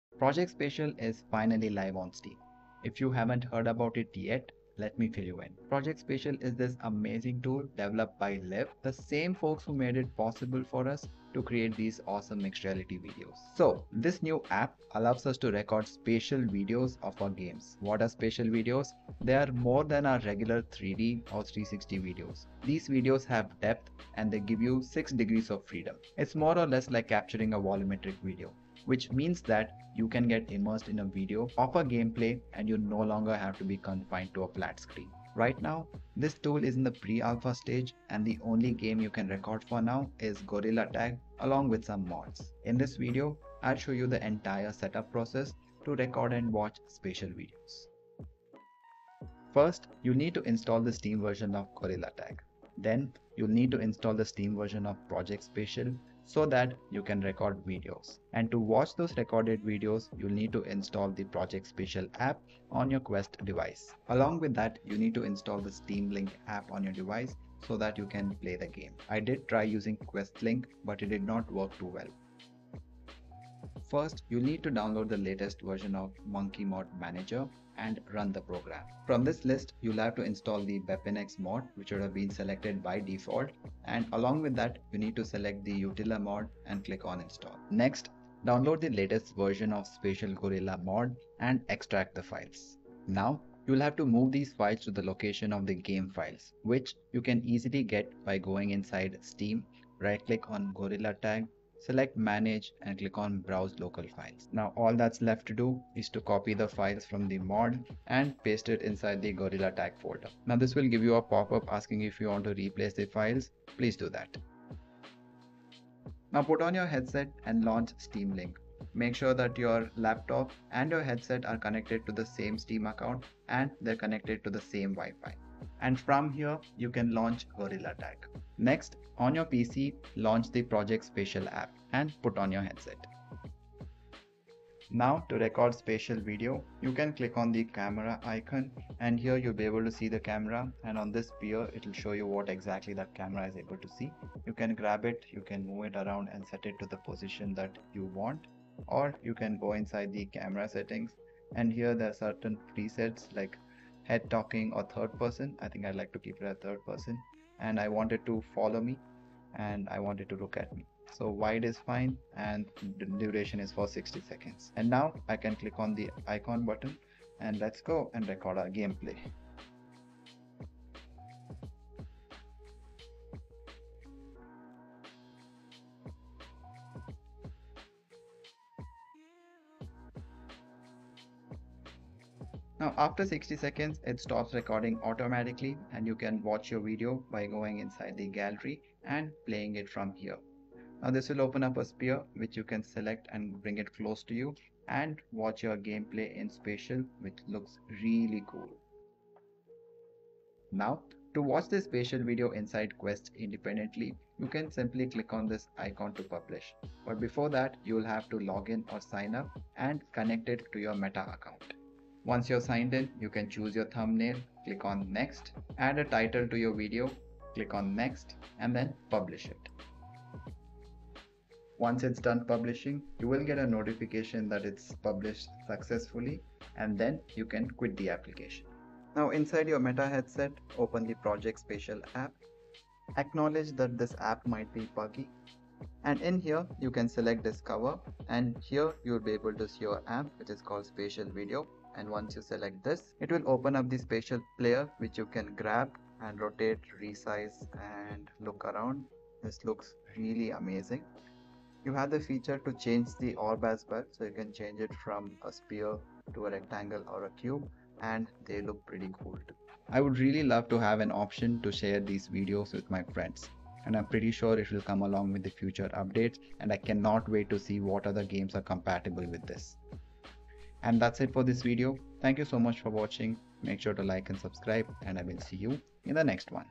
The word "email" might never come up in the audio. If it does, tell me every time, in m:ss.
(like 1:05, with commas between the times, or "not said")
not said.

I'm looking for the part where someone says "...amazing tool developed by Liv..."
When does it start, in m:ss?
0:06.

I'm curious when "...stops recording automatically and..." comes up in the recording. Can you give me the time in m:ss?
3:04.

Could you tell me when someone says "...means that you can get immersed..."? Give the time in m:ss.
0:29.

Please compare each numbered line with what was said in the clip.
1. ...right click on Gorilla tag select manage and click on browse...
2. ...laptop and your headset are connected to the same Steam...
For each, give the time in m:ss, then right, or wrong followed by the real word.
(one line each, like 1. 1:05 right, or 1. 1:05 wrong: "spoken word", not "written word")
1. 1:39 right
2. 1:59 right.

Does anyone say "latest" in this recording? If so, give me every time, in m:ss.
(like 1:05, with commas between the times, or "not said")
1:15, 1:28.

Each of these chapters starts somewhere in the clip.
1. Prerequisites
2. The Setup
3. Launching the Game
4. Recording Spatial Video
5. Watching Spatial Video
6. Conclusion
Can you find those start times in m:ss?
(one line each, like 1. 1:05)
1. 0:48
2. 1:11
3. 1:54
4. 2:13
5. 3:19
6. 4:20.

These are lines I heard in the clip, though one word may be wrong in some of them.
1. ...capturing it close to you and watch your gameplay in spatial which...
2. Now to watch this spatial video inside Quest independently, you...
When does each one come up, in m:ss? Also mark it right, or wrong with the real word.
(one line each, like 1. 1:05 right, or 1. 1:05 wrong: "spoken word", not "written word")
1. 3:13 wrong: "bring", not "capturing"
2. 3:20 right.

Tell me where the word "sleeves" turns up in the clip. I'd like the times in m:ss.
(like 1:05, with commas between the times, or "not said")
not said.